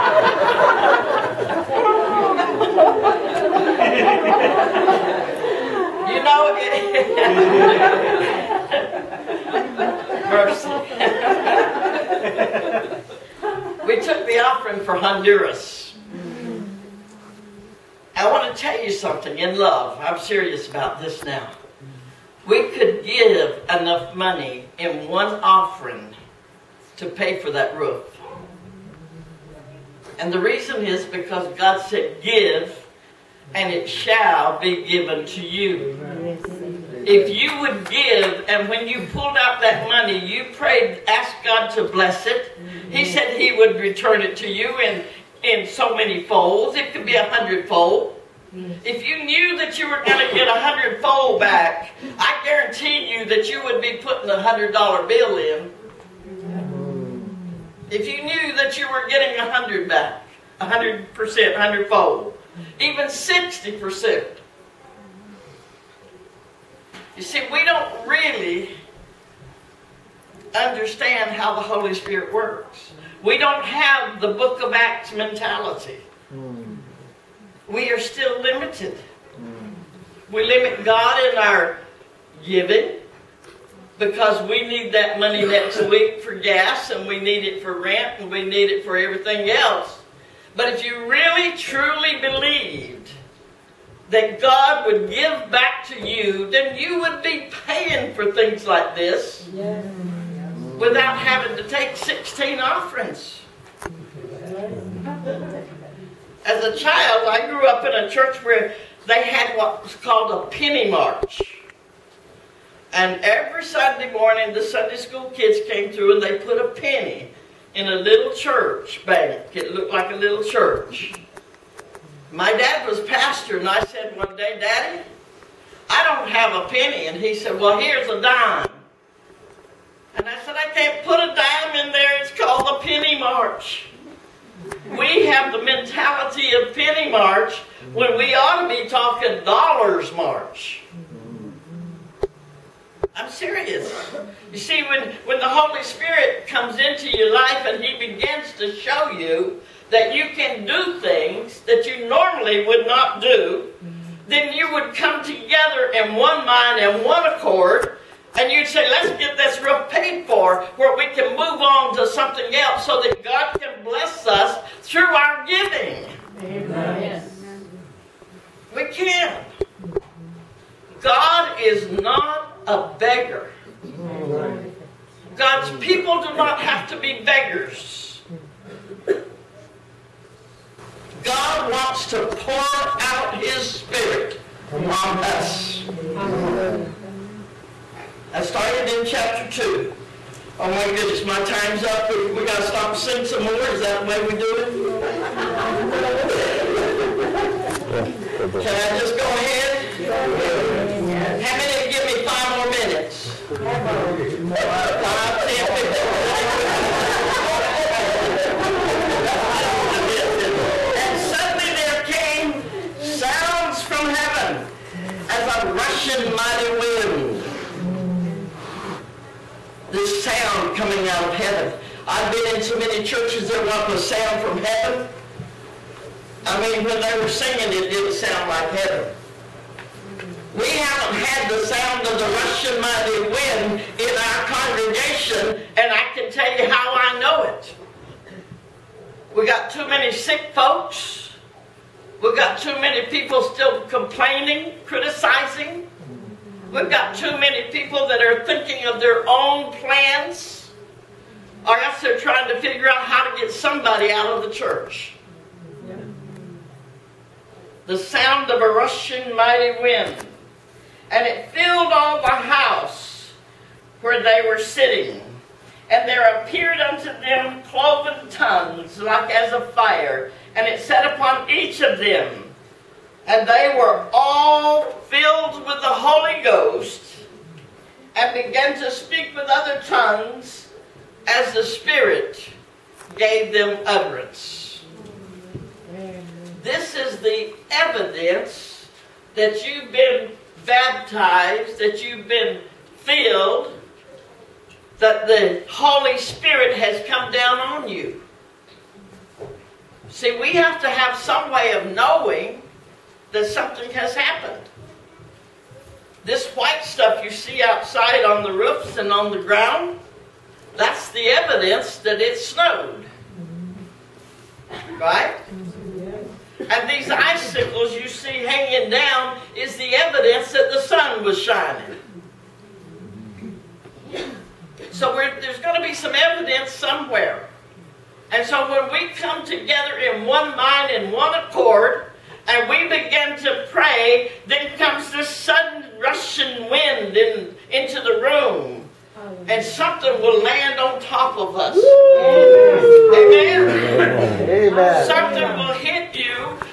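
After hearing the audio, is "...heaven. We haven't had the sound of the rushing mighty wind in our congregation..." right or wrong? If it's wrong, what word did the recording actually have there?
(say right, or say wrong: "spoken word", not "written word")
right.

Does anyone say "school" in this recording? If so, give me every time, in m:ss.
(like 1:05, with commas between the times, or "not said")
1:54.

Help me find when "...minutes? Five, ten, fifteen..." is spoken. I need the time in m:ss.
3:22.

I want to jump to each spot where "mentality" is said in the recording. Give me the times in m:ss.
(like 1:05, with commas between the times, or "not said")
1:15, 2:15.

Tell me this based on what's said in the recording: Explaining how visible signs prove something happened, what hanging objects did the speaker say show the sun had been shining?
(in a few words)
icicles.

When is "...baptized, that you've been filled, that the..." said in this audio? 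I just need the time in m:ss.
4:50.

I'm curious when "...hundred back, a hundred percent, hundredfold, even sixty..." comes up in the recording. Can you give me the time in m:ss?
0:59.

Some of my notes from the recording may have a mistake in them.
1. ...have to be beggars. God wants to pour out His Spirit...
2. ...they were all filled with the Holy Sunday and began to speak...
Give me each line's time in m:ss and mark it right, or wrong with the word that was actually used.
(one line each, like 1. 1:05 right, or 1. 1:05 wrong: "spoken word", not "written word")
1. 2:56 right
2. 4:33 wrong: "Ghost", not "Sunday".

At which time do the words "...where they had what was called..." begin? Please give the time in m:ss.
1:48.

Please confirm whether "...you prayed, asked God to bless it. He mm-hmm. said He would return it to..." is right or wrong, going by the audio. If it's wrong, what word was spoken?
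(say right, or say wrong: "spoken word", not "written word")
right.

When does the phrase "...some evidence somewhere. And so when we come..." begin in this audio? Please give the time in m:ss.
5:25.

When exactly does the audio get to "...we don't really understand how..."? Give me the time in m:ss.
1:07.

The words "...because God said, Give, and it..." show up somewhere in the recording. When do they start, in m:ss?
0:31.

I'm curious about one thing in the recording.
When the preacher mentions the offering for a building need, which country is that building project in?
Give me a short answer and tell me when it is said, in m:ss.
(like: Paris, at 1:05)
Honduras, at 0:14.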